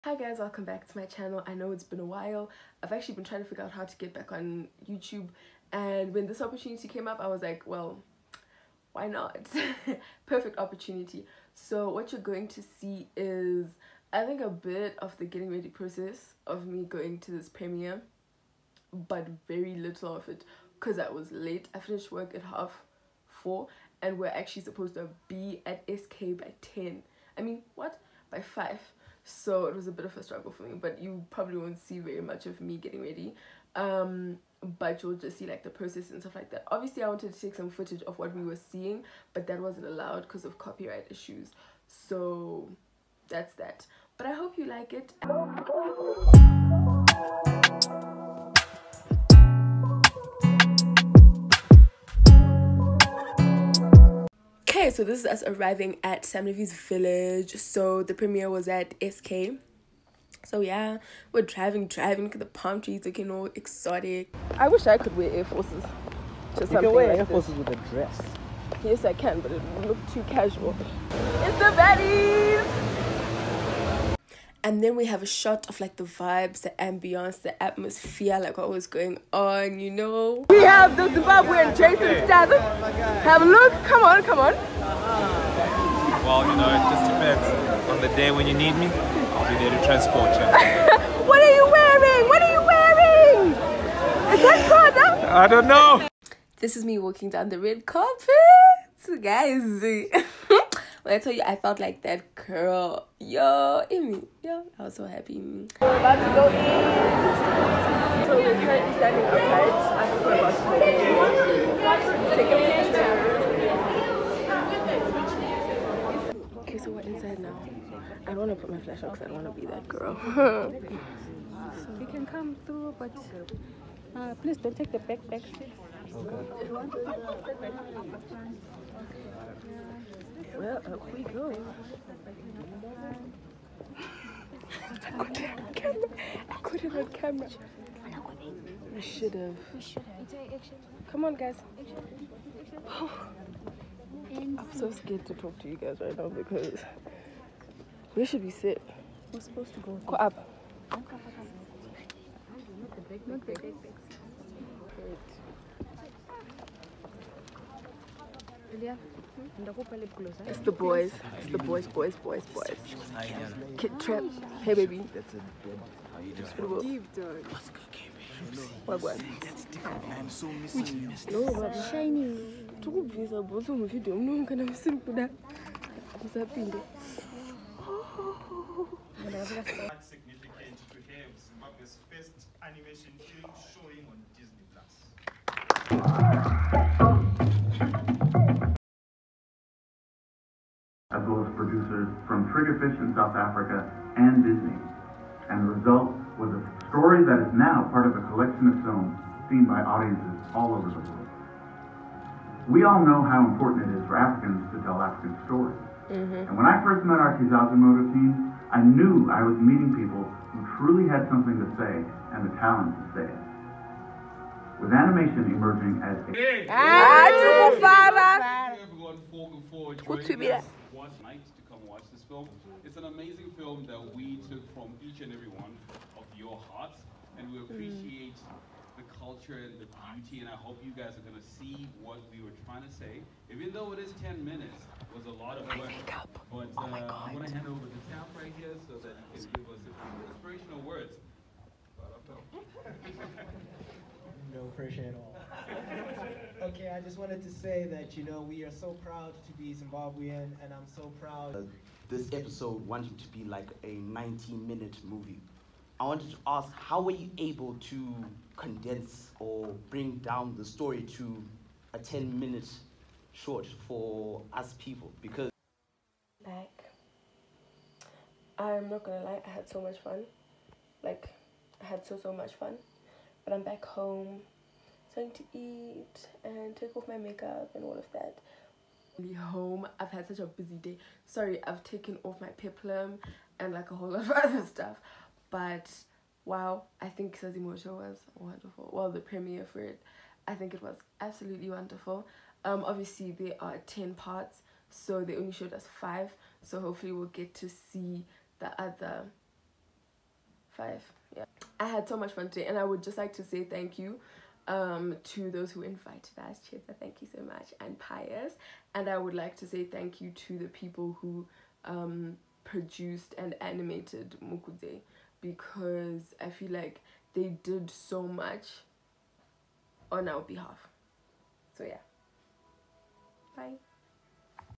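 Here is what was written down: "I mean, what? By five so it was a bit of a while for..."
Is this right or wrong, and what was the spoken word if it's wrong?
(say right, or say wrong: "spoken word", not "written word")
wrong: "struggle", not "while".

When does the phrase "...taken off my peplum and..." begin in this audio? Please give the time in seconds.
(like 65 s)
281 s.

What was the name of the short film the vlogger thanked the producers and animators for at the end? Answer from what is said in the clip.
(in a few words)
Mukude.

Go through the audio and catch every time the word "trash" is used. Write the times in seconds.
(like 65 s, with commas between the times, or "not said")
not said.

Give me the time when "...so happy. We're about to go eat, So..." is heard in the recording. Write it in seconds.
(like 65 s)
104 s.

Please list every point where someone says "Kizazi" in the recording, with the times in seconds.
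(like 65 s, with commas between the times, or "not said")
207 s, 287 s.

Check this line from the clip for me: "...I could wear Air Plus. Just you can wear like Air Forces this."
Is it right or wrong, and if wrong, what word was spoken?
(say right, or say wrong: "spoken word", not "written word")
wrong: "Forces", not "Plus".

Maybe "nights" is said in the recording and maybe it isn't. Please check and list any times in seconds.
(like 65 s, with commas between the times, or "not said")
221 s.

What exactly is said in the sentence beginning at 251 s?
Uh, this episode wanted to be like a 90-minute movie.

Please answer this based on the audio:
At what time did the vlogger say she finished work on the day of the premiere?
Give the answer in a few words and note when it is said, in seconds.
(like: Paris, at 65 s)
4:30, at 22 s.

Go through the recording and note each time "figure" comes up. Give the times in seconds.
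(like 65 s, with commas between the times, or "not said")
3 s.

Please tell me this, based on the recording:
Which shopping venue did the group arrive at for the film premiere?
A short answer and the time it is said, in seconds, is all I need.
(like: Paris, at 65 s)
Sam Levy's Village, at 56 s.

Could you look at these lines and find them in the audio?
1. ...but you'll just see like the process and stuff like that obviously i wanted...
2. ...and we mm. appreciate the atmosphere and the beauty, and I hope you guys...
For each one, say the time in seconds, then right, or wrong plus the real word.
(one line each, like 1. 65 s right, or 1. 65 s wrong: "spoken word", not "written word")
1. 34 s right
2. 227 s wrong: "culture", not "atmosphere".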